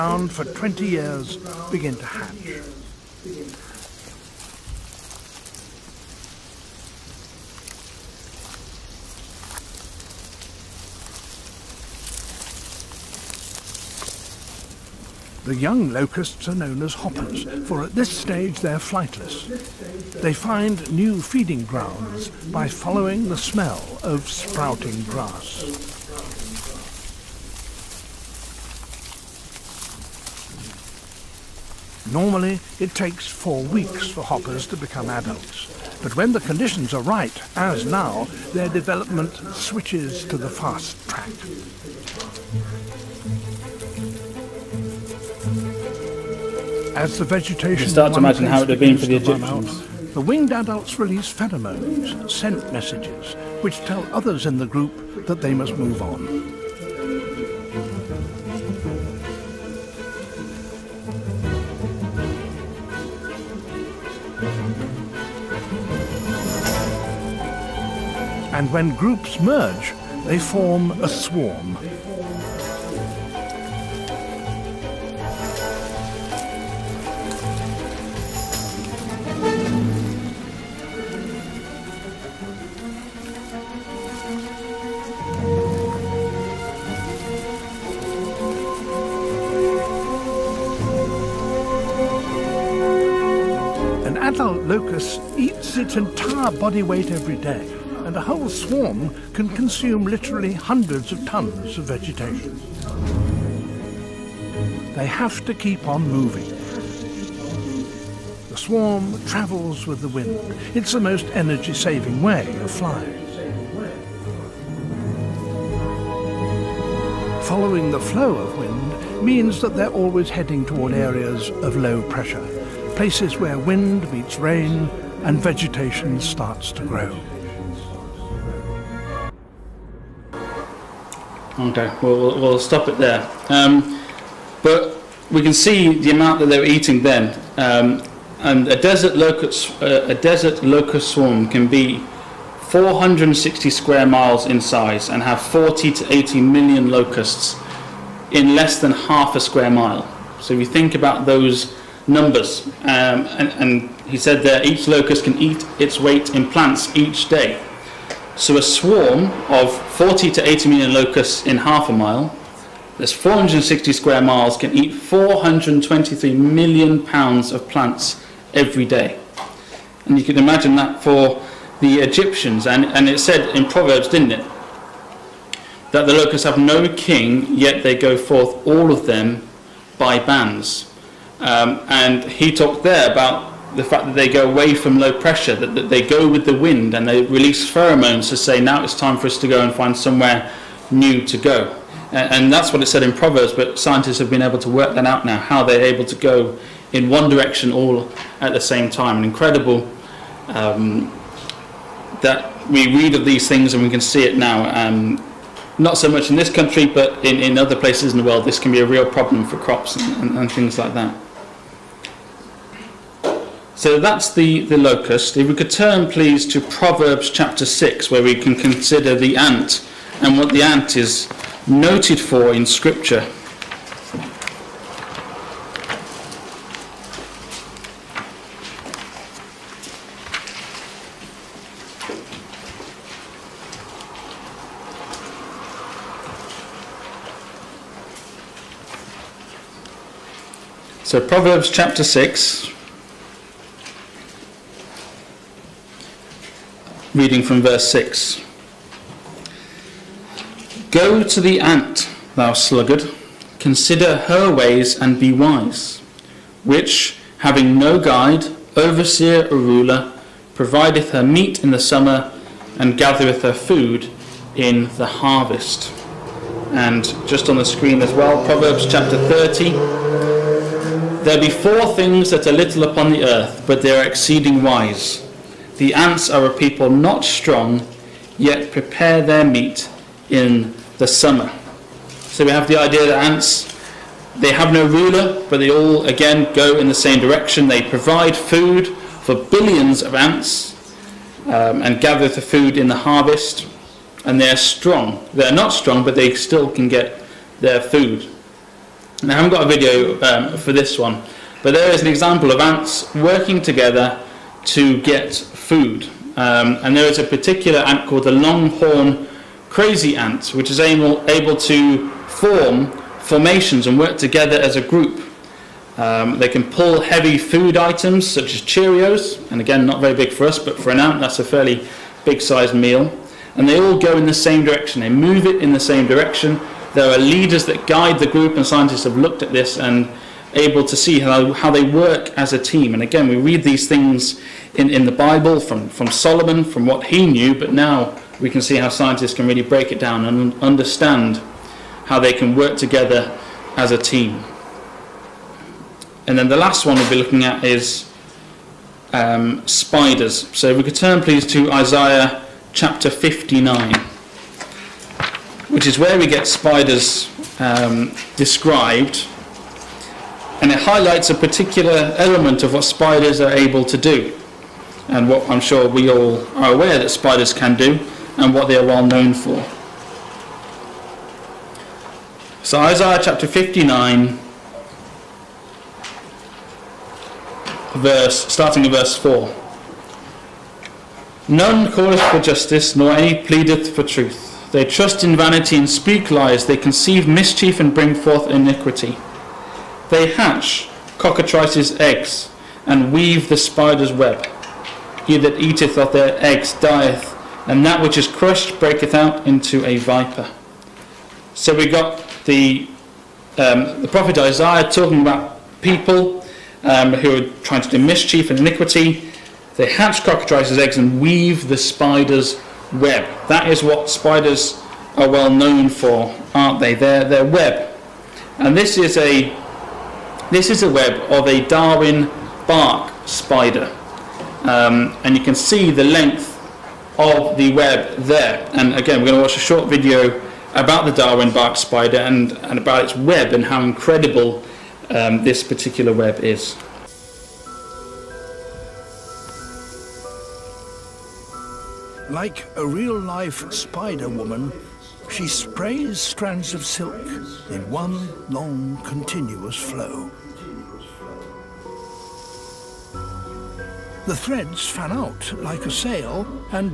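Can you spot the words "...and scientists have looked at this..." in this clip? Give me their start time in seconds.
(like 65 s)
328 s.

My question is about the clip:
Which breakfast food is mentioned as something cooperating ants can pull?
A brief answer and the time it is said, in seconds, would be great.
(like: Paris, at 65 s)
Cheerios, at 318 s.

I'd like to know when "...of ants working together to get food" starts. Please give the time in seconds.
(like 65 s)
302 s.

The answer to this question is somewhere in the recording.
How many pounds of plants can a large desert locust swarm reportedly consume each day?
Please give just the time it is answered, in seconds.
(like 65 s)
164 s.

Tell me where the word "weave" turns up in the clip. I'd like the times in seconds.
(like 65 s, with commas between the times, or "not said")
393 s, 411 s.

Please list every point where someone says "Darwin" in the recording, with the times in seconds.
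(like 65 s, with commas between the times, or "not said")
421 s, 431 s.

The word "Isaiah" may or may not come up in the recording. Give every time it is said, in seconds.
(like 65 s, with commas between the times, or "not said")
351 s, 372 s, 404 s.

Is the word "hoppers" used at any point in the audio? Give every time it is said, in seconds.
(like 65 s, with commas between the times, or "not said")
16 s, 34 s.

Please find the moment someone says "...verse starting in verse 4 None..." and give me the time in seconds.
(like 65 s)
378 s.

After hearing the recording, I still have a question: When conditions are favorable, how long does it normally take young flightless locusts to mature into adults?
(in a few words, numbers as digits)
4 weeks.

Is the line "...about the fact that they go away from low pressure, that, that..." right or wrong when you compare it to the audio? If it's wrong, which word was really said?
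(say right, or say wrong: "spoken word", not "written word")
right.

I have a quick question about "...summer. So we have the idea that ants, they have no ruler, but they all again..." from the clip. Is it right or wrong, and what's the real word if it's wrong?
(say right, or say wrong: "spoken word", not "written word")
right.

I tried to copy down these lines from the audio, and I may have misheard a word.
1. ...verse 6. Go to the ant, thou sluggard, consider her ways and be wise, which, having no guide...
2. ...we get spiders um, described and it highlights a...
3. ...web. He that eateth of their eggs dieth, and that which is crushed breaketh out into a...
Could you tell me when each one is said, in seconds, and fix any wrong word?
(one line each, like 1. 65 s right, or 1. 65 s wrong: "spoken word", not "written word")
1. 247 s right
2. 356 s right
3. 394 s right.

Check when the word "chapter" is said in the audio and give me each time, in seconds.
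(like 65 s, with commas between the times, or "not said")
217 s, 241 s, 268 s, 352 s, 373 s.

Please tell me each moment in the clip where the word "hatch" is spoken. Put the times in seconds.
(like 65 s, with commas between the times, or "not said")
2 s, 390 s, 409 s.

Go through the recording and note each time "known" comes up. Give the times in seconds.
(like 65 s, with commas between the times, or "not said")
16 s, 369 s, 415 s.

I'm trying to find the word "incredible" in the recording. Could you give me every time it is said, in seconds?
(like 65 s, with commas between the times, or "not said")
199 s, 433 s.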